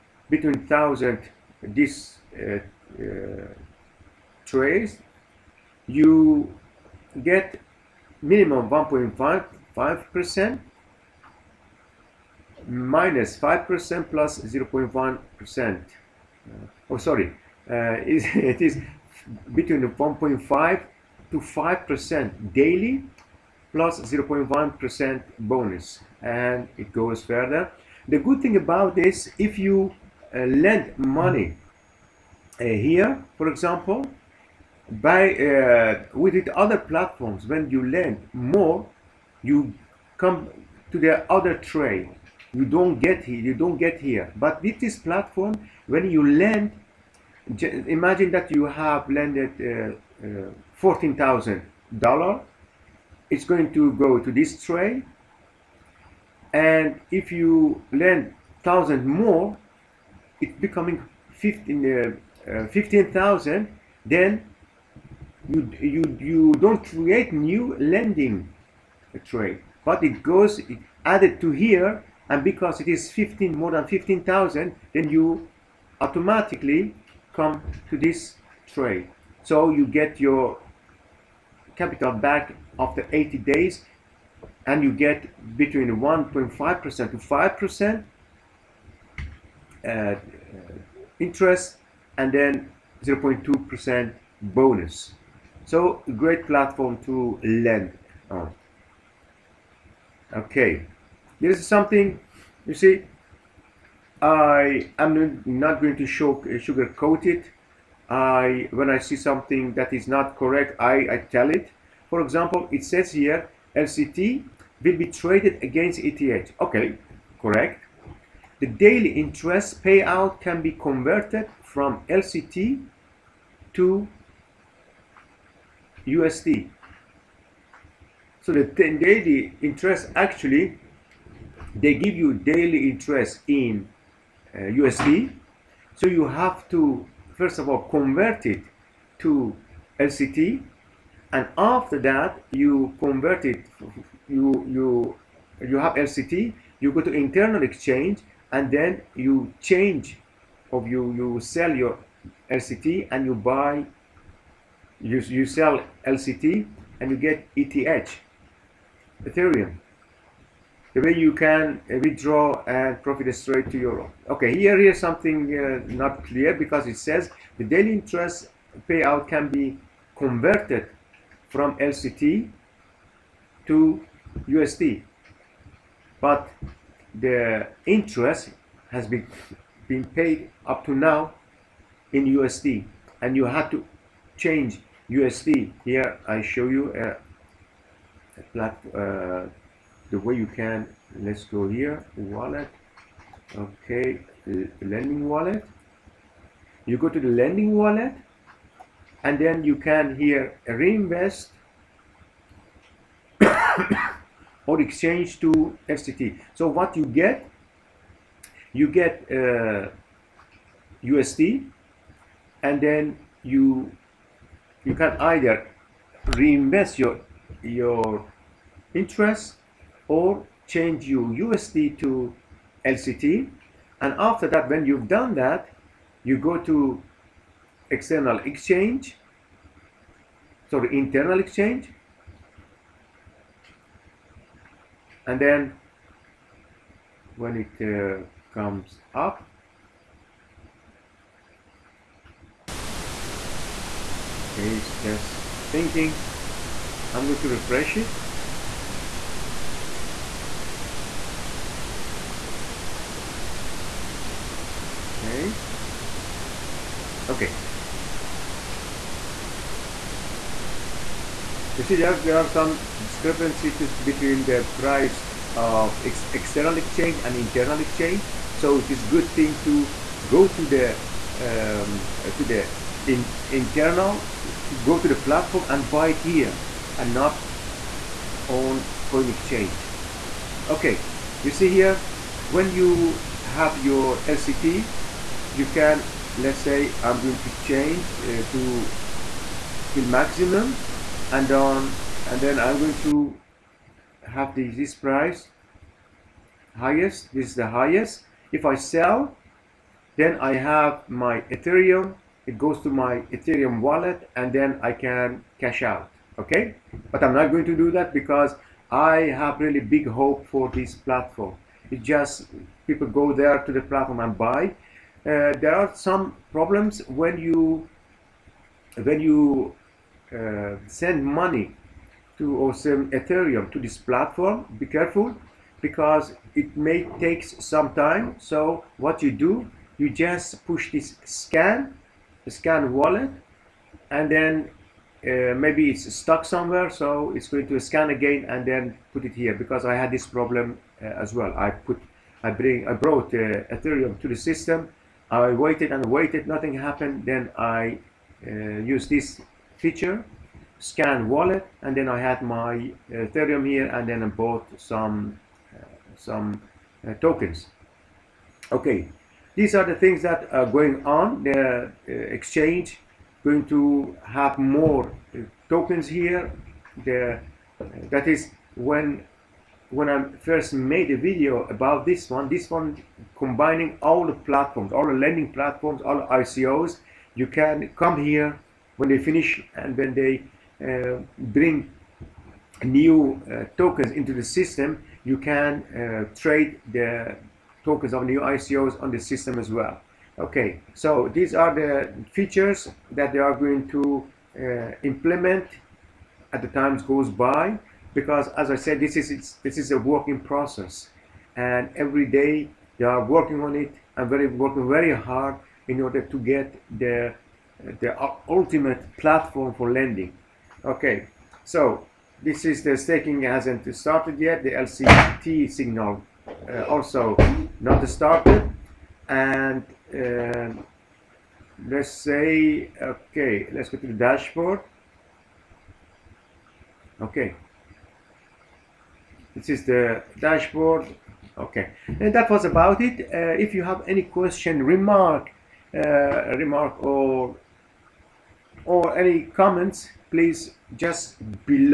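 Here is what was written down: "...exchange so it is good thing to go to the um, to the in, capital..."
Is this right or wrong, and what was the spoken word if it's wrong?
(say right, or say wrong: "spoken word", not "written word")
wrong: "internal", not "capital".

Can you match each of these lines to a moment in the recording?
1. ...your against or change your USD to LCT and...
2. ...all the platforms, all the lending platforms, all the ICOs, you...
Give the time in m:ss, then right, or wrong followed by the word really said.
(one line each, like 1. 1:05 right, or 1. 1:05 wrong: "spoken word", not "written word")
1. 3:37 wrong: "interest", not "against"
2. 6:14 right.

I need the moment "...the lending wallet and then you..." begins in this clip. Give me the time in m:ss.
3:17.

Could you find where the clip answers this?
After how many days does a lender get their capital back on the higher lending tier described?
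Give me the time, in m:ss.
1:23.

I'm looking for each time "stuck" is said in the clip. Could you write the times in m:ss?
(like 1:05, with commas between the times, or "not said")
5:36.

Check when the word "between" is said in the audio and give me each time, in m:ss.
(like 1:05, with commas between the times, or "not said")
0:00, 0:19, 1:25, 4:23.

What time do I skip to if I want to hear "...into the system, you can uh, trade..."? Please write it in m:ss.
6:24.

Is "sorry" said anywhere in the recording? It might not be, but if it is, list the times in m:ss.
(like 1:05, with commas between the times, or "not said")
0:16, 3:50.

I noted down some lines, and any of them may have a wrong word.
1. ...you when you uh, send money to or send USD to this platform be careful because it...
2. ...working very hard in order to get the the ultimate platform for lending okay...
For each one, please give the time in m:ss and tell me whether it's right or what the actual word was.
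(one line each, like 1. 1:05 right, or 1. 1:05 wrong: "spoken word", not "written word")
1. 5:17 wrong: "Ethereum", not "USD"
2. 6:44 right.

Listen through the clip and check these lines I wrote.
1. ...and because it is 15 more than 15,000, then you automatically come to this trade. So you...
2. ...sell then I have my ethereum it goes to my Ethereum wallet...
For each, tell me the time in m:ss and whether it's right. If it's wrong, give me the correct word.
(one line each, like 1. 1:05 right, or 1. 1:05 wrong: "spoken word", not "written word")
1. 1:12 right
2. 4:58 right.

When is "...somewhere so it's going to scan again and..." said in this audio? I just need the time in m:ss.
5:36.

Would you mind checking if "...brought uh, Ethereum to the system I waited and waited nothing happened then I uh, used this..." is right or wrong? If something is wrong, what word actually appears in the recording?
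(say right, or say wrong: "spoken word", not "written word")
right.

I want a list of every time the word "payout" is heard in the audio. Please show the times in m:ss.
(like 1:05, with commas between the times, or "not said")
1:59, 2:48.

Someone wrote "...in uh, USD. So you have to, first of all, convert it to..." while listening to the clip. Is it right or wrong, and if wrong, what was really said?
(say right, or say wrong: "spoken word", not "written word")
right.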